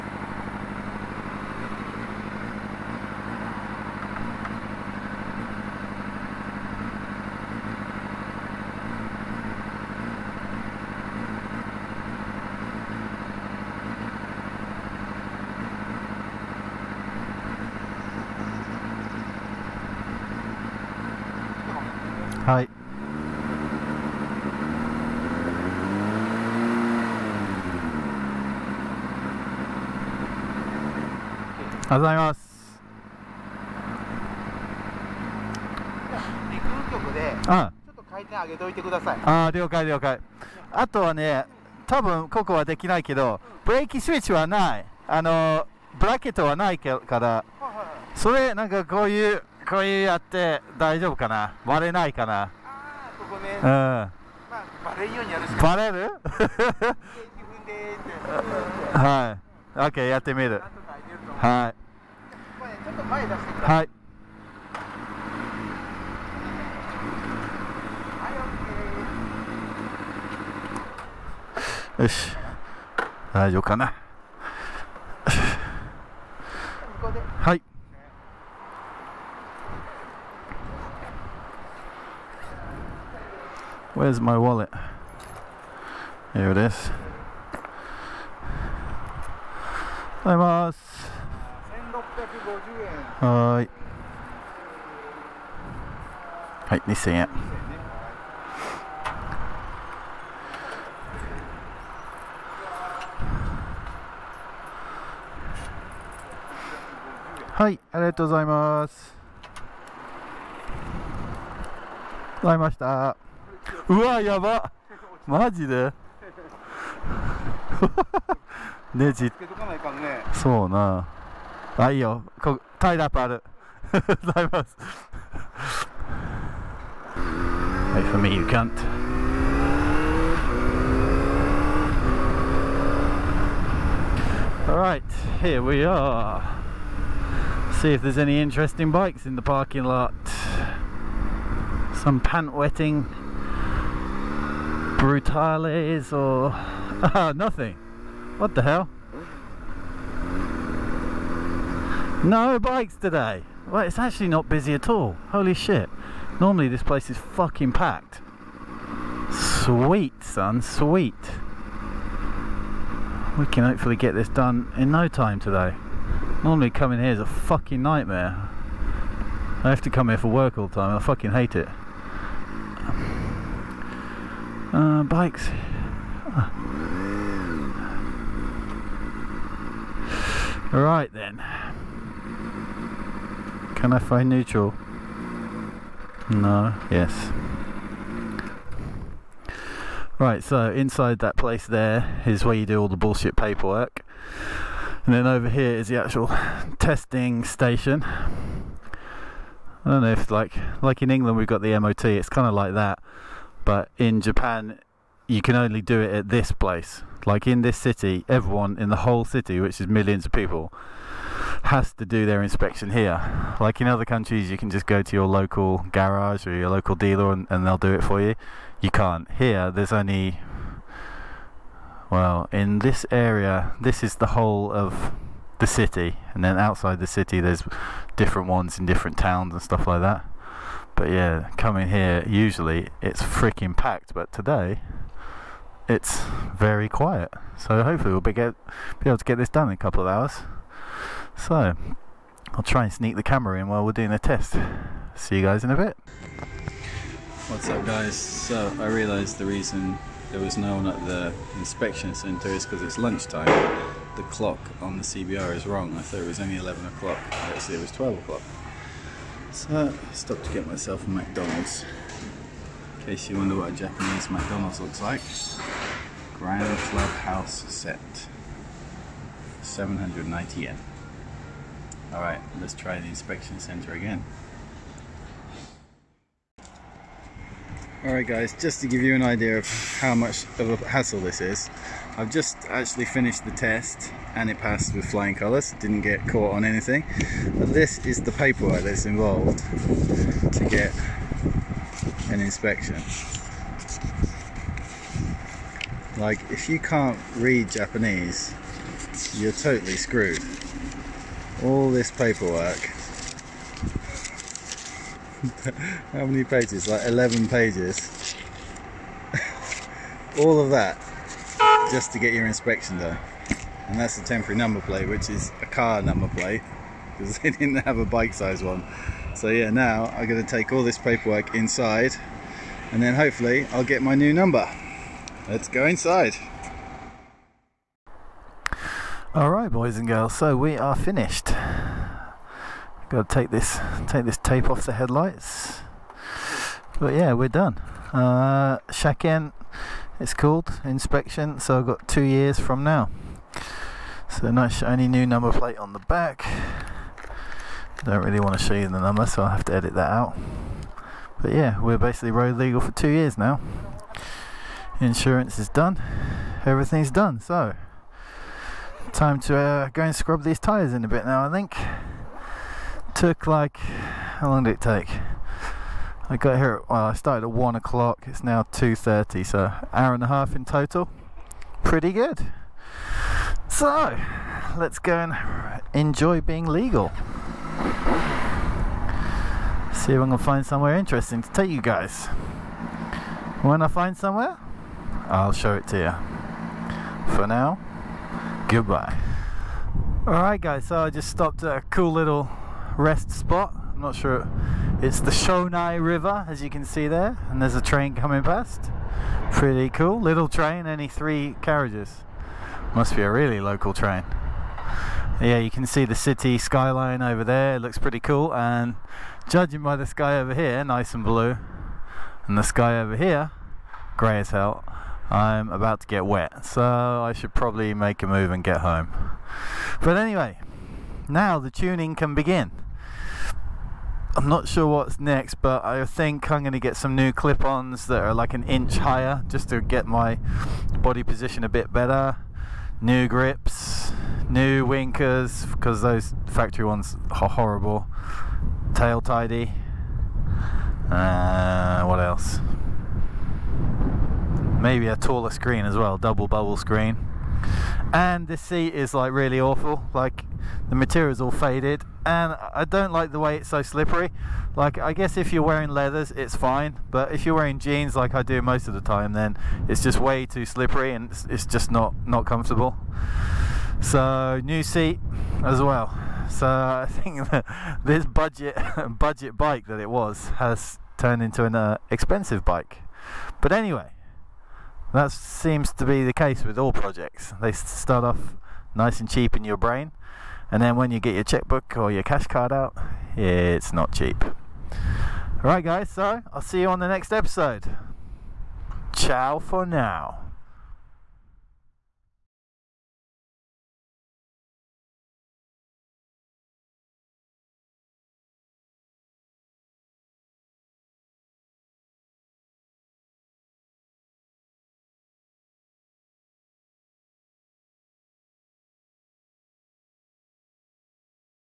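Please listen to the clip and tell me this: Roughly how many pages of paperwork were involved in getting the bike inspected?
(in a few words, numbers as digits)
11.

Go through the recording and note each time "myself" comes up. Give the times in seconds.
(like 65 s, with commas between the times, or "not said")
260 s.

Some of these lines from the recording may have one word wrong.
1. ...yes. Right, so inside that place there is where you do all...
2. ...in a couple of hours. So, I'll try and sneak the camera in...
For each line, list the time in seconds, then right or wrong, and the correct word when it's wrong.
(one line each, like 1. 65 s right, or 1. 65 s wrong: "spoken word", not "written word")
1. 186 s right
2. 239 s right.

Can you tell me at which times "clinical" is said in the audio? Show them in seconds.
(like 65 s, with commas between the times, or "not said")
not said.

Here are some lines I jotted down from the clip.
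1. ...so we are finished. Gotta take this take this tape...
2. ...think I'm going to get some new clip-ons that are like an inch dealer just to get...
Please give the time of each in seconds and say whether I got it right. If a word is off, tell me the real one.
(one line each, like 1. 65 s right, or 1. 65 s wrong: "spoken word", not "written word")
1. 330 s right
2. 426 s wrong: "higher", not "dealer".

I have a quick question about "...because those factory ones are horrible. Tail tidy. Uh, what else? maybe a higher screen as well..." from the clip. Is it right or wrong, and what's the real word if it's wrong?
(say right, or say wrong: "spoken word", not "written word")
wrong: "taller", not "higher".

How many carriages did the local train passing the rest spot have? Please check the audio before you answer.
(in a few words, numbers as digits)
3.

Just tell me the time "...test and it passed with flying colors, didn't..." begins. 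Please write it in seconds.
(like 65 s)
283 s.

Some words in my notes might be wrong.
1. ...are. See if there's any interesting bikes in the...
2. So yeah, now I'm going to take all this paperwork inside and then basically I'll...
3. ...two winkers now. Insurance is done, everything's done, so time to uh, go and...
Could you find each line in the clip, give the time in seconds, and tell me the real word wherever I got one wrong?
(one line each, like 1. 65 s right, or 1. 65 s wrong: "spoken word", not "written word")
1. 135 s right
2. 319 s wrong: "hopefully", not "basically"
3. 352 s wrong: "years", not "winkers".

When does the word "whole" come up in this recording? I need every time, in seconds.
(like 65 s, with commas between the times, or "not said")
209 s, 224 s.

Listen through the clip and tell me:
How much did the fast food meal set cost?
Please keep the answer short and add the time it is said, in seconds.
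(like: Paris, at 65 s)
790 yen, at 269 s.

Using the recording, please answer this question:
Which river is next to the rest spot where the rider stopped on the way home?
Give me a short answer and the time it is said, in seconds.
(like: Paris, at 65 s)
Shonai River, at 395 s.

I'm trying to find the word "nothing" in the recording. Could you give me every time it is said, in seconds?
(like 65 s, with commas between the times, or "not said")
147 s.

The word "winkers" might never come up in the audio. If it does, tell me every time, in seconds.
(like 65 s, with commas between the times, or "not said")
434 s.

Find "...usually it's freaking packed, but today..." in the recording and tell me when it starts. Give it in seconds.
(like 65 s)
232 s.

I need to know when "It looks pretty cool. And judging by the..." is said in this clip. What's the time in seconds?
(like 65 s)
407 s.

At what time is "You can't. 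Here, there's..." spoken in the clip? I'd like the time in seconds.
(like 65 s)
218 s.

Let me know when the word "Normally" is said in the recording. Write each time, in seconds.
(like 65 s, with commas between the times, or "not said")
156 s, 166 s.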